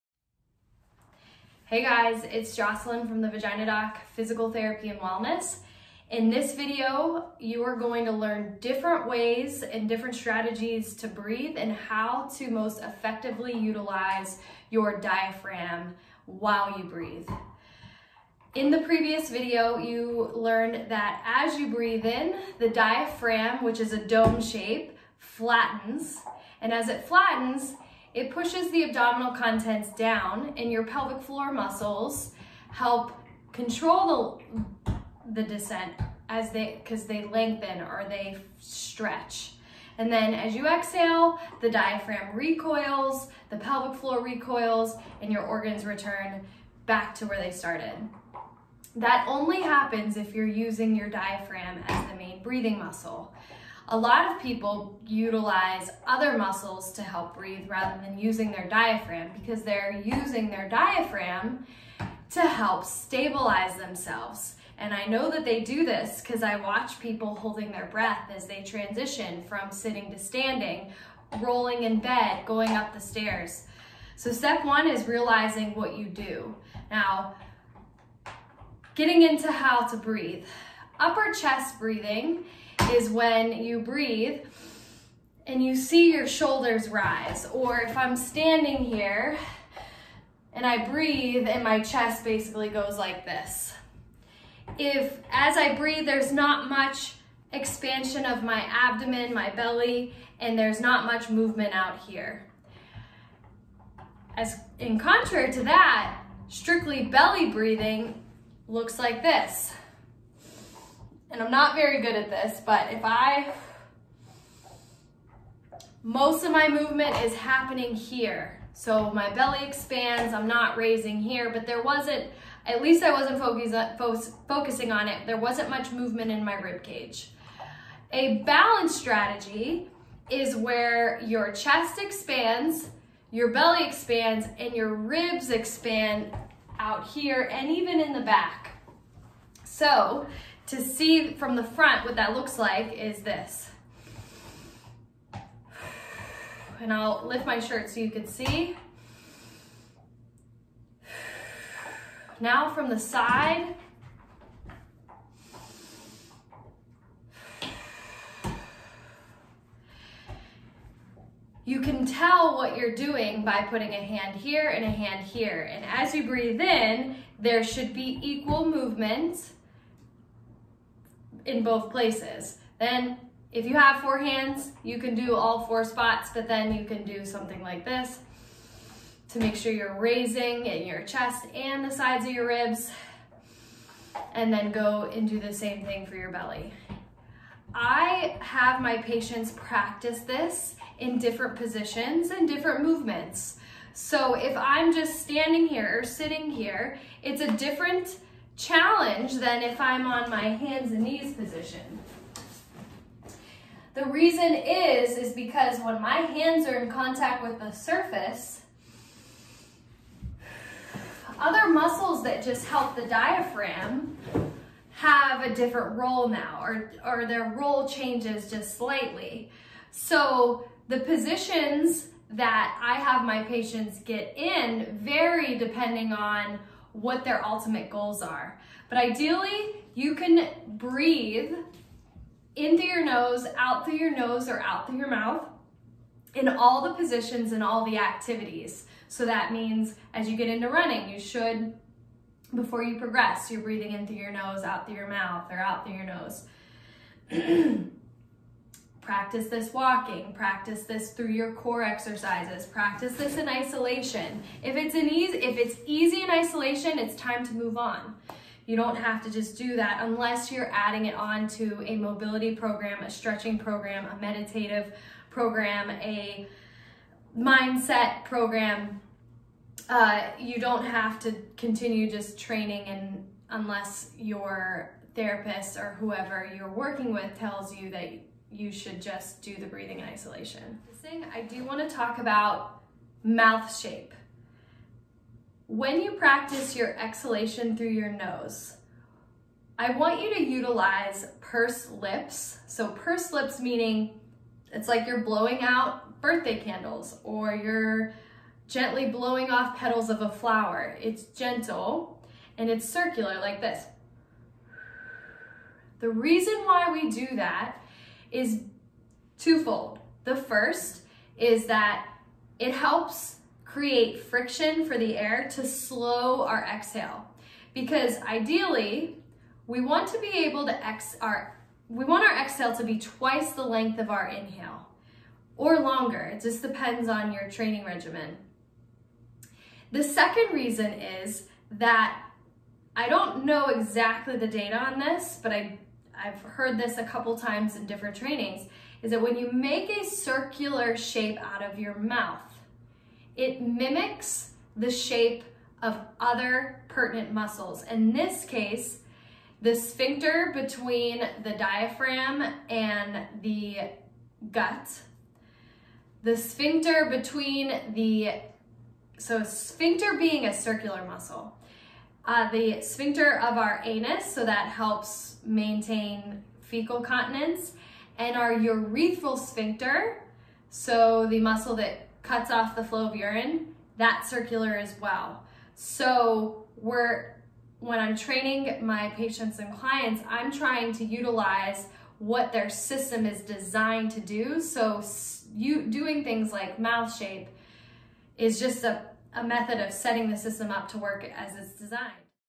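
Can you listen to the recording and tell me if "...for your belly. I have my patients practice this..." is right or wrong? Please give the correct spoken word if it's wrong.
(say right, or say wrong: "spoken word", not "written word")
right.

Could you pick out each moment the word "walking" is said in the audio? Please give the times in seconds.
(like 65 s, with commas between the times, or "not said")
249 s.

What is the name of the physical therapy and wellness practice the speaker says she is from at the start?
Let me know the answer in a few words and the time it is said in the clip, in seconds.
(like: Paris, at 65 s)
The Vagina Doc, at 3 s.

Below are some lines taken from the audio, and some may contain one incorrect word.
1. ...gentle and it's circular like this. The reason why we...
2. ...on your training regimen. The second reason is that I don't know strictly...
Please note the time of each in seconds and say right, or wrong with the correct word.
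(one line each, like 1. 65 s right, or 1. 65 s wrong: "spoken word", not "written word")
1. 301 s right
2. 327 s wrong: "exactly", not "strictly".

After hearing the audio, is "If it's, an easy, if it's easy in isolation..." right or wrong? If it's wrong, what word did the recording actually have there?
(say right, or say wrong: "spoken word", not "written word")
right.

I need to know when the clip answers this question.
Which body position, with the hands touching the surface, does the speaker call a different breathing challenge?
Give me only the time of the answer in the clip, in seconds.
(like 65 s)
200 s.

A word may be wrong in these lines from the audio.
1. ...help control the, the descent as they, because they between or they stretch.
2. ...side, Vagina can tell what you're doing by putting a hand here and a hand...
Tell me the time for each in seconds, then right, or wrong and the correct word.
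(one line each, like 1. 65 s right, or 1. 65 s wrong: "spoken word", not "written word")
1. 32 s wrong: "lengthen", not "between"
2. 152 s wrong: "You", not "Vagina".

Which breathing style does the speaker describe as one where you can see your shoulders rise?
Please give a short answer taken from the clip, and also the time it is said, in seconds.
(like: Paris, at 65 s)
Upper chest breathing, at 80 s.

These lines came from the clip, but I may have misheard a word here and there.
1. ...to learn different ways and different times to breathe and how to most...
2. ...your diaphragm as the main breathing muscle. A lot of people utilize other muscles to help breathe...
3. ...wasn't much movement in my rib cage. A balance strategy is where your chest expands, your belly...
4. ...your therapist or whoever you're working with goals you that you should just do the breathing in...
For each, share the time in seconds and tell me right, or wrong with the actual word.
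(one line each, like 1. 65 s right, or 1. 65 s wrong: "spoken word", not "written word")
1. 8 s wrong: "strategies", not "times"
2. 50 s right
3. 125 s right
4. 274 s wrong: "tells", not "goals".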